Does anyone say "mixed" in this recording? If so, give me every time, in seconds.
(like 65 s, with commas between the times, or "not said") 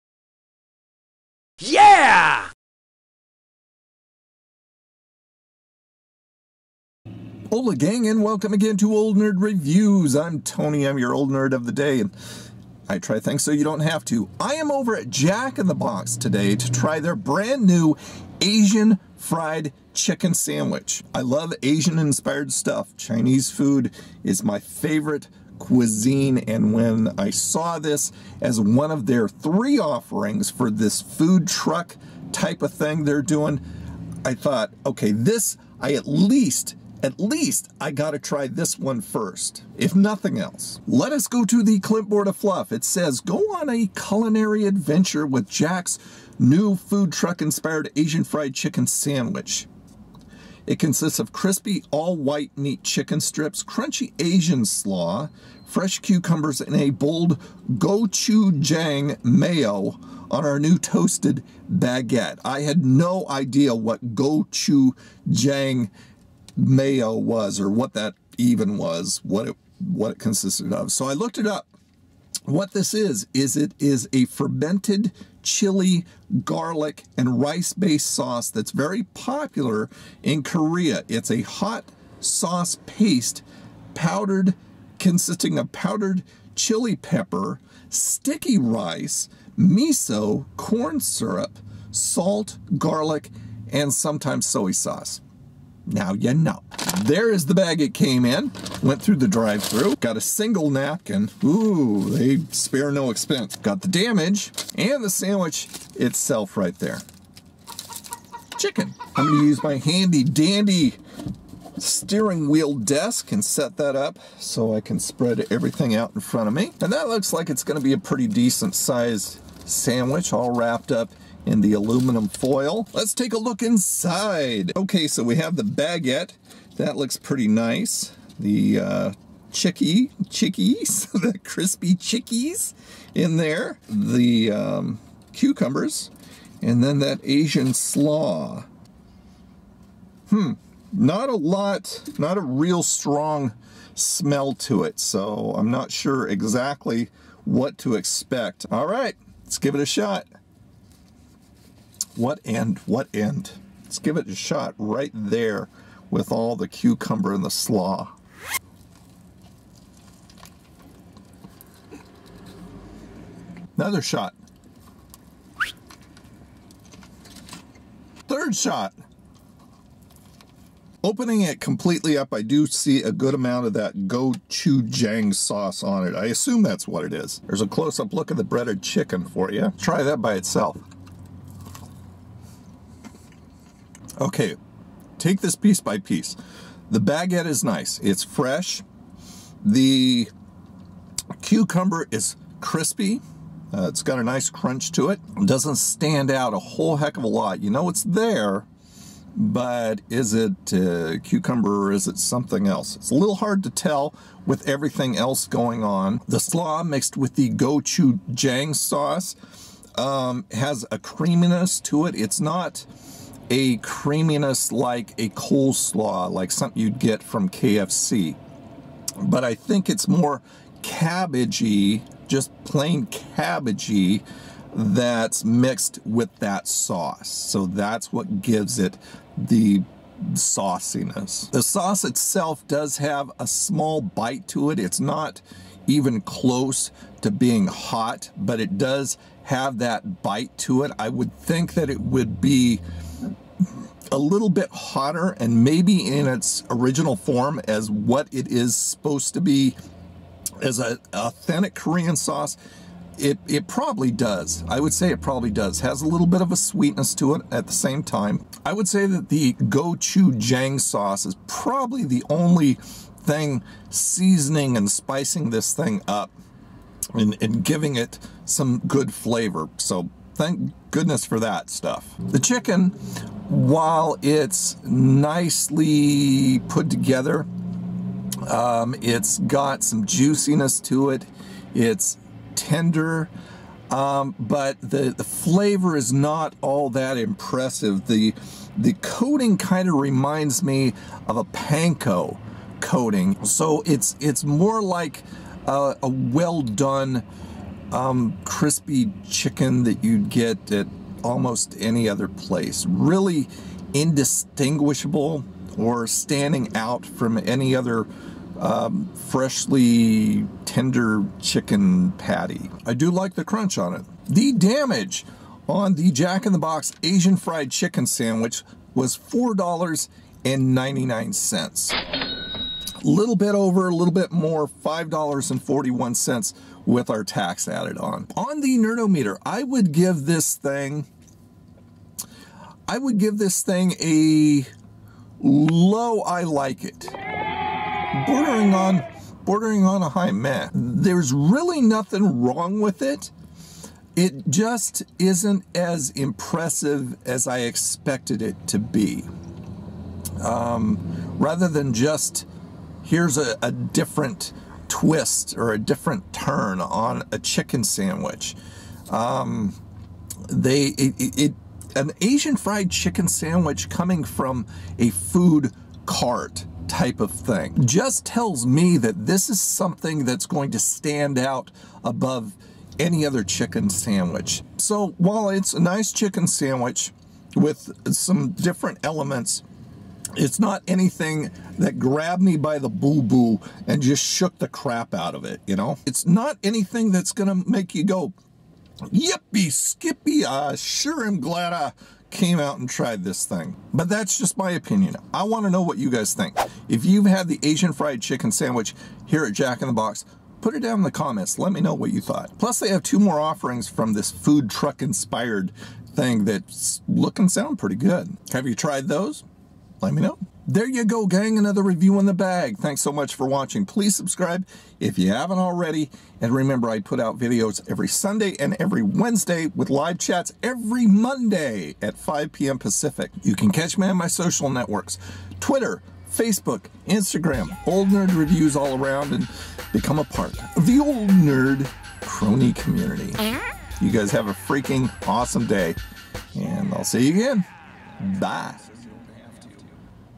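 206 s, 225 s.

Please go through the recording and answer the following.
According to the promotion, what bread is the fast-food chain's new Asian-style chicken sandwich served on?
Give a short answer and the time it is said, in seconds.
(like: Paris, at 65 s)
toasted baguette, at 60 s.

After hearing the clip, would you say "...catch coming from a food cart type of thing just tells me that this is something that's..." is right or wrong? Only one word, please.
wrong.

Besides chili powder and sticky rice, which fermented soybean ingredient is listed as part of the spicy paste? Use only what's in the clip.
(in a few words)
miso.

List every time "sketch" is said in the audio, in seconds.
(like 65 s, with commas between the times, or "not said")
not said.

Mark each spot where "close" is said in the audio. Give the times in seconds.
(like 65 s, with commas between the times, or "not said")
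177 s, 236 s.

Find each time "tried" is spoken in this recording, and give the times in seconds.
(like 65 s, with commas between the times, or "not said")
392 s, 408 s.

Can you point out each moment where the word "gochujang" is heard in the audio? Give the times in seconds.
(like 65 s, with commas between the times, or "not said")
57 s, 64 s, 174 s, 207 s, 259 s.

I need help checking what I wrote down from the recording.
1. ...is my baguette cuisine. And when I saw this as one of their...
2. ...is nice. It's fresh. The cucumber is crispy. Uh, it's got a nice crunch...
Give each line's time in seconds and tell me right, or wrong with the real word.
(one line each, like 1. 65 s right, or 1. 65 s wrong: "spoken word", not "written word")
1. 24 s wrong: "favorite", not "baguette"
2. 187 s right.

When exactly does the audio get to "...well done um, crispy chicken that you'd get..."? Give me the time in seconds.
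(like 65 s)
296 s.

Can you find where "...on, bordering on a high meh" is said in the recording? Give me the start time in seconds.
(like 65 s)
338 s.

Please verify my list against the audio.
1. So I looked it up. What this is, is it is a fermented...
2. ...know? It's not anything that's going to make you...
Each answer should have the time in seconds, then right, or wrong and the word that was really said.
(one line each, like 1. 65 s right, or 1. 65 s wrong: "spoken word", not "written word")
1. 70 s right
2. 385 s right.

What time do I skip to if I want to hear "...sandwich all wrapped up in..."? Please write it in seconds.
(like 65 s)
119 s.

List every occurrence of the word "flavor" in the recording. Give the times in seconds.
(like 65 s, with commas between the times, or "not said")
269 s, 285 s.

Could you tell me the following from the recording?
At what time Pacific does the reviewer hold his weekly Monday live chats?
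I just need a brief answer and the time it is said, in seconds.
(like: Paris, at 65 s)
5 p.m., at 422 s.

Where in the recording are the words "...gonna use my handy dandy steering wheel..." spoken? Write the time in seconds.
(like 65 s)
109 s.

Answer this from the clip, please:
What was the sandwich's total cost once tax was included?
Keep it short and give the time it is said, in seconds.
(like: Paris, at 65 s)
$5.41, at 324 s.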